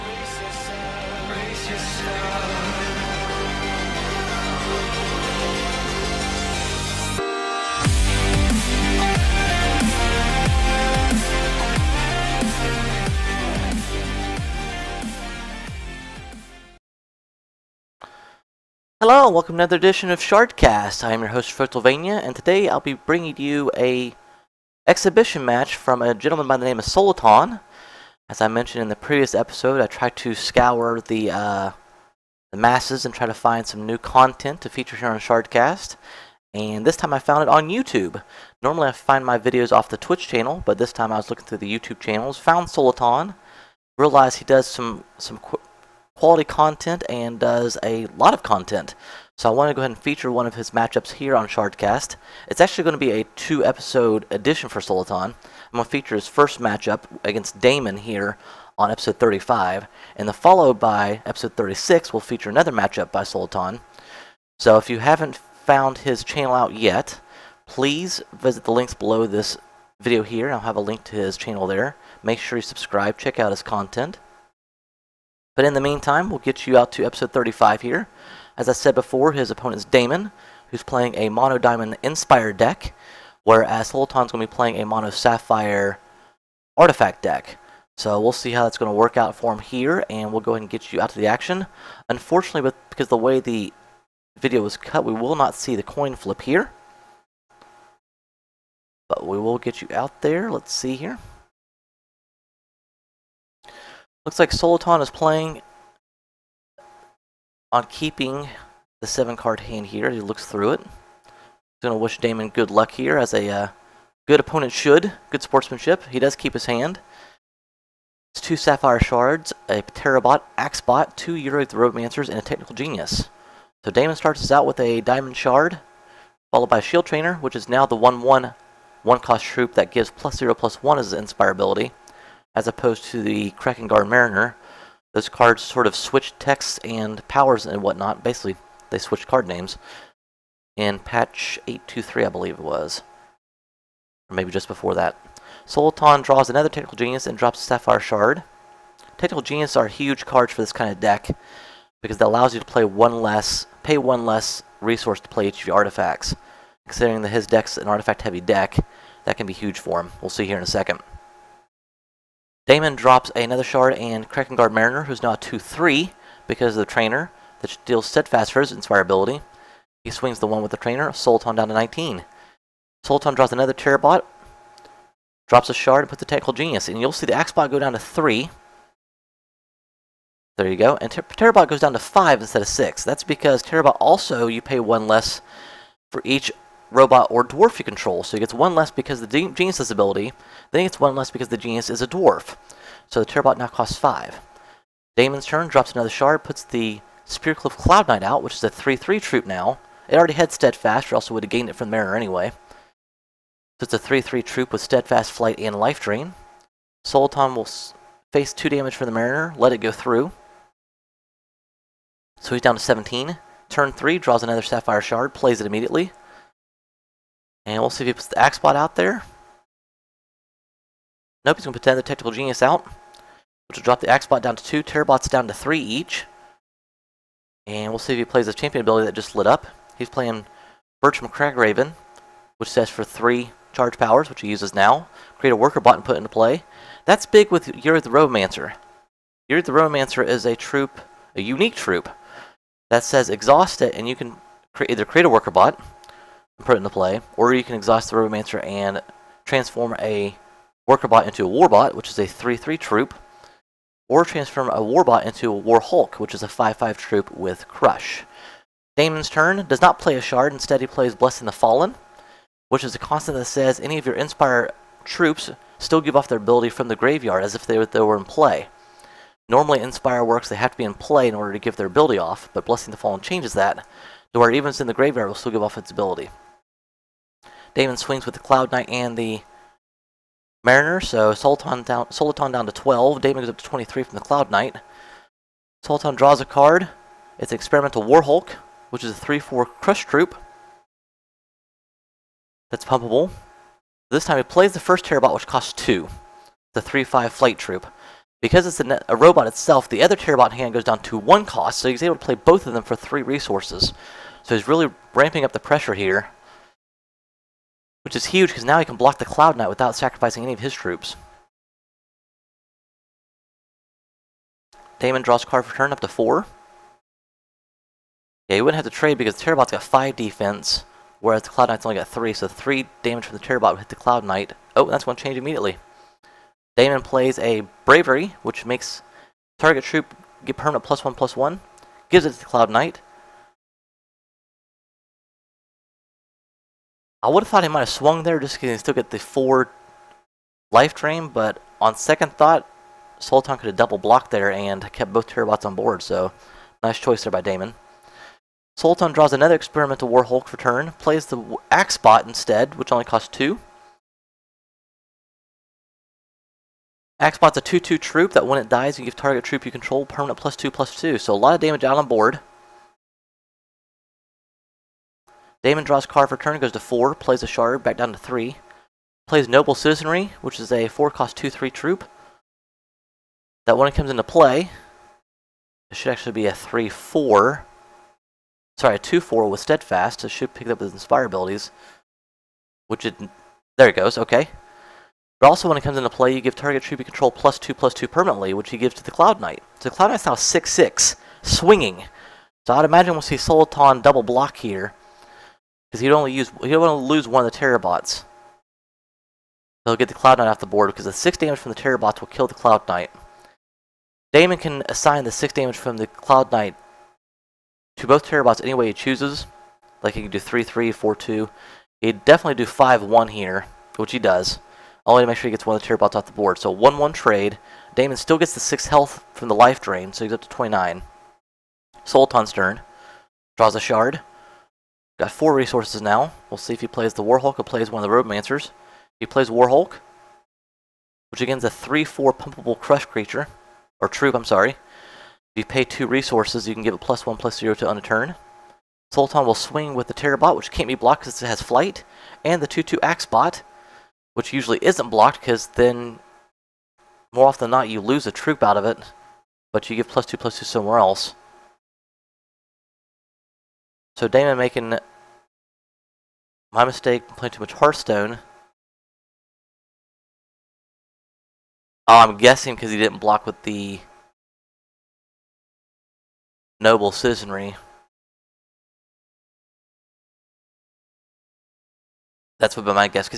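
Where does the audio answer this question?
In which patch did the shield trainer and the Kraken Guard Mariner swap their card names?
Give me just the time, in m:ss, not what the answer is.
2:20.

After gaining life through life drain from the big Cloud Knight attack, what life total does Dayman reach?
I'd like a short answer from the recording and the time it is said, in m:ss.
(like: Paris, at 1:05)
29, at 7:00.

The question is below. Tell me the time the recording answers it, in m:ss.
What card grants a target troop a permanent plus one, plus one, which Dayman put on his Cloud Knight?
5:27.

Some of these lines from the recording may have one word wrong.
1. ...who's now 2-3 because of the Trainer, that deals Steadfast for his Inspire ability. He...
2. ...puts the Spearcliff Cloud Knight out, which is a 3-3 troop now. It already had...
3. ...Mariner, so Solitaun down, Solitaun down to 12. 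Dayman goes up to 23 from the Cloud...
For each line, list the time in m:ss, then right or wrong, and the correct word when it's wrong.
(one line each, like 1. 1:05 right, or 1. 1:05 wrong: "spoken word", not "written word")
1. 2:45 right
2. 3:16 right
3. 4:40 right.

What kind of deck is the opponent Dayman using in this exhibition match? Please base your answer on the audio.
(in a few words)
Mono Diamond Inspire.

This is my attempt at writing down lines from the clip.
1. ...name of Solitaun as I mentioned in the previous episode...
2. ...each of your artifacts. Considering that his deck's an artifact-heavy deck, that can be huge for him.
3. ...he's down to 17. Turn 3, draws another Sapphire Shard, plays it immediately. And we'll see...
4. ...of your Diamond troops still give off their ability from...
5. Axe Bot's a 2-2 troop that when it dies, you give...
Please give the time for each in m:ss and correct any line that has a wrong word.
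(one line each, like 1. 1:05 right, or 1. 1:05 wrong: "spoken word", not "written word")
1. 0:26 right
2. 2:35 right
3. 3:32 right
4. 4:23 wrong: "Inspire", not "Diamond"
5. 5:57 right.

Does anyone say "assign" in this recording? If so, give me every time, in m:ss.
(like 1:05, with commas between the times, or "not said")
6:44.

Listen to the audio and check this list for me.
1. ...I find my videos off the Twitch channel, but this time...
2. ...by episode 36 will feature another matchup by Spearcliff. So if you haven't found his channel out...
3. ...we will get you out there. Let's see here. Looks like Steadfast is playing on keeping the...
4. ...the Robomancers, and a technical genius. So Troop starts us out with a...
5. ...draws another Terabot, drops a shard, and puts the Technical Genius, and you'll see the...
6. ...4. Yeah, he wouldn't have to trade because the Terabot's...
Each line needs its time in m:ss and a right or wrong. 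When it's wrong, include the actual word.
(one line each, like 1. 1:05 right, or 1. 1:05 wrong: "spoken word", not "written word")
1. 0:38 right
2. 1:00 wrong: "Solitaun", not "Spearcliff"
3. 1:39 wrong: "Solitaun", not "Steadfast"
4. 2:01 wrong: "Dayman", not "Troop"
5. 2:53 right
6. 5:16 right.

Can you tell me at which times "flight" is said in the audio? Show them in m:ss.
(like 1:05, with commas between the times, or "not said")
3:25, 4:57, 7:21.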